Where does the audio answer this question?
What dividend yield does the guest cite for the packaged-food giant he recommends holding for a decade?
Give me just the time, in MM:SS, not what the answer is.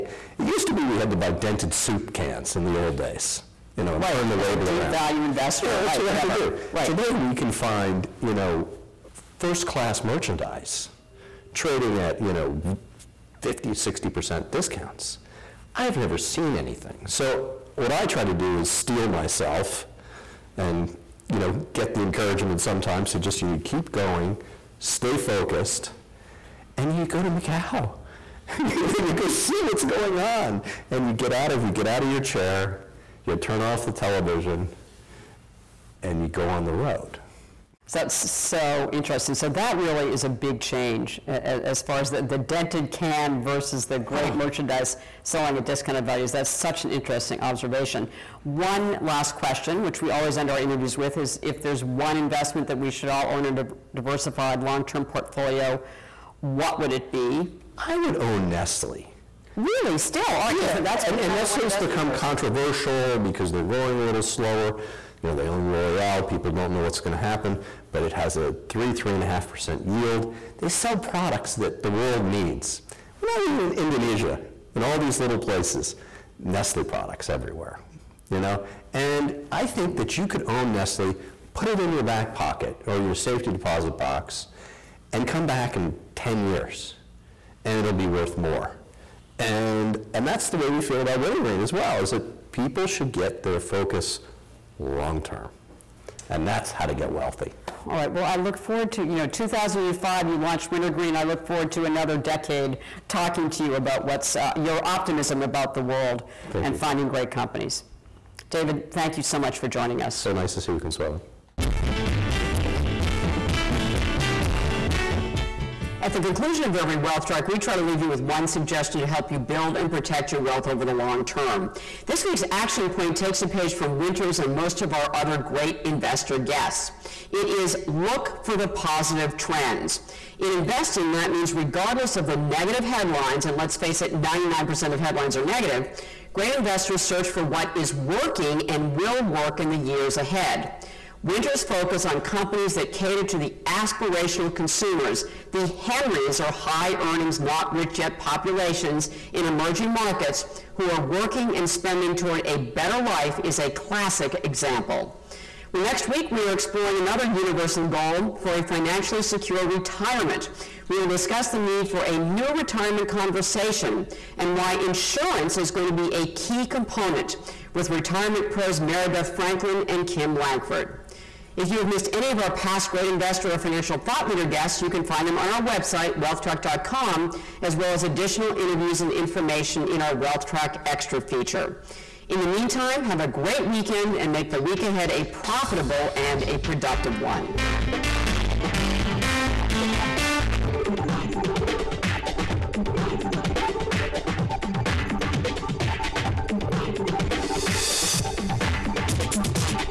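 01:08.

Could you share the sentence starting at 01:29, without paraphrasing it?
And, and that's the way we feel about Wintergreen as well, is that people should get their focus long term.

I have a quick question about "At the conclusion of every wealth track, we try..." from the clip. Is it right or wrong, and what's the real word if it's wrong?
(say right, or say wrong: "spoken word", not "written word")
right.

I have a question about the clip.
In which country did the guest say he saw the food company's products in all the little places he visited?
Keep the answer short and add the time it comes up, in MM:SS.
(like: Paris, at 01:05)
Indonesia, at 01:13.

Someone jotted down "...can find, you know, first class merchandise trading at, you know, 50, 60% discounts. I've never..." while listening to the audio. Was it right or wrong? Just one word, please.
right.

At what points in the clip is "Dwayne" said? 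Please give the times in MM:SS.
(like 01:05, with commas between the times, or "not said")
not said.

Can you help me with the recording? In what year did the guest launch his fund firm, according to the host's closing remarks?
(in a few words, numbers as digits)
2005.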